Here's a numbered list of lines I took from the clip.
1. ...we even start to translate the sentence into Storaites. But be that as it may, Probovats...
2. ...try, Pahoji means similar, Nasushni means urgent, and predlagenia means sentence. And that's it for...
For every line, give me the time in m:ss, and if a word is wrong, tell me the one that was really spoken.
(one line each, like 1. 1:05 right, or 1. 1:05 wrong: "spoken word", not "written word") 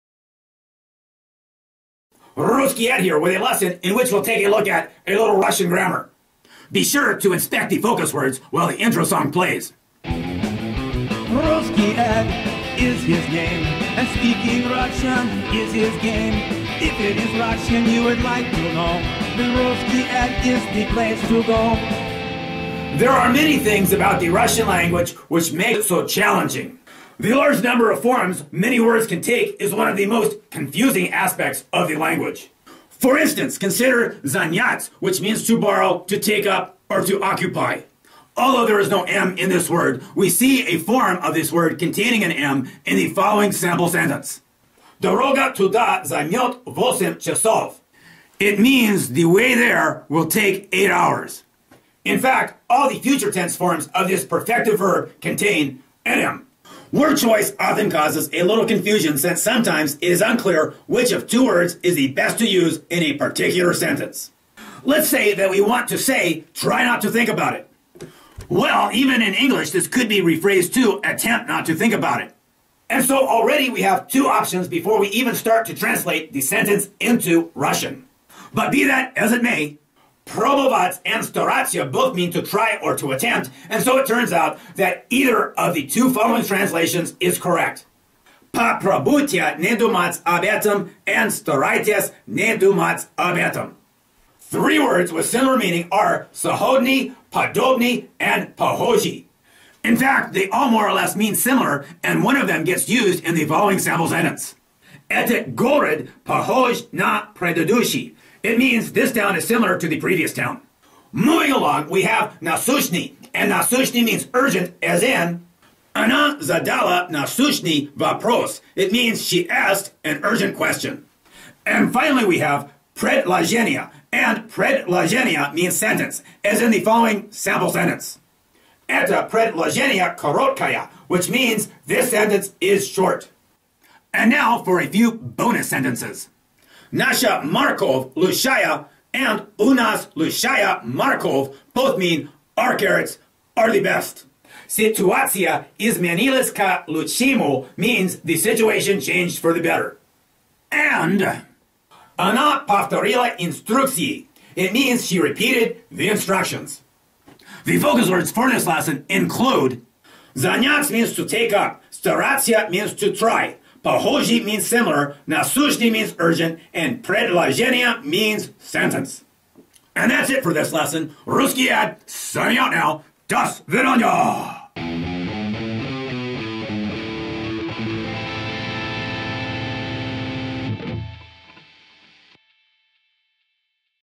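1. 1:14 wrong: "Russian", not "Storaites"
2. 2:43 right.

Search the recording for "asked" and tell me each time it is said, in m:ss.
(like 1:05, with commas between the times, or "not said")
1:59.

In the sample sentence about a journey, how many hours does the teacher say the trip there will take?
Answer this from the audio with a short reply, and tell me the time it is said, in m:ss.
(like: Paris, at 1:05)
8, at 0:50.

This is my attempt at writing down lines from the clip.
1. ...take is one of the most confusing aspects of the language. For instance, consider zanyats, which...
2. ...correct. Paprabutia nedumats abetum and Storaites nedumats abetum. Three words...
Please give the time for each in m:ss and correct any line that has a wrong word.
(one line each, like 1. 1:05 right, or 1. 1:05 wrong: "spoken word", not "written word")
1. 0:29 right
2. 1:27 right.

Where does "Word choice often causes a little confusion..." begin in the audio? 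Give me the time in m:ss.
0:56.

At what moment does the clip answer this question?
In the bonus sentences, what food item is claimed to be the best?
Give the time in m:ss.
2:22.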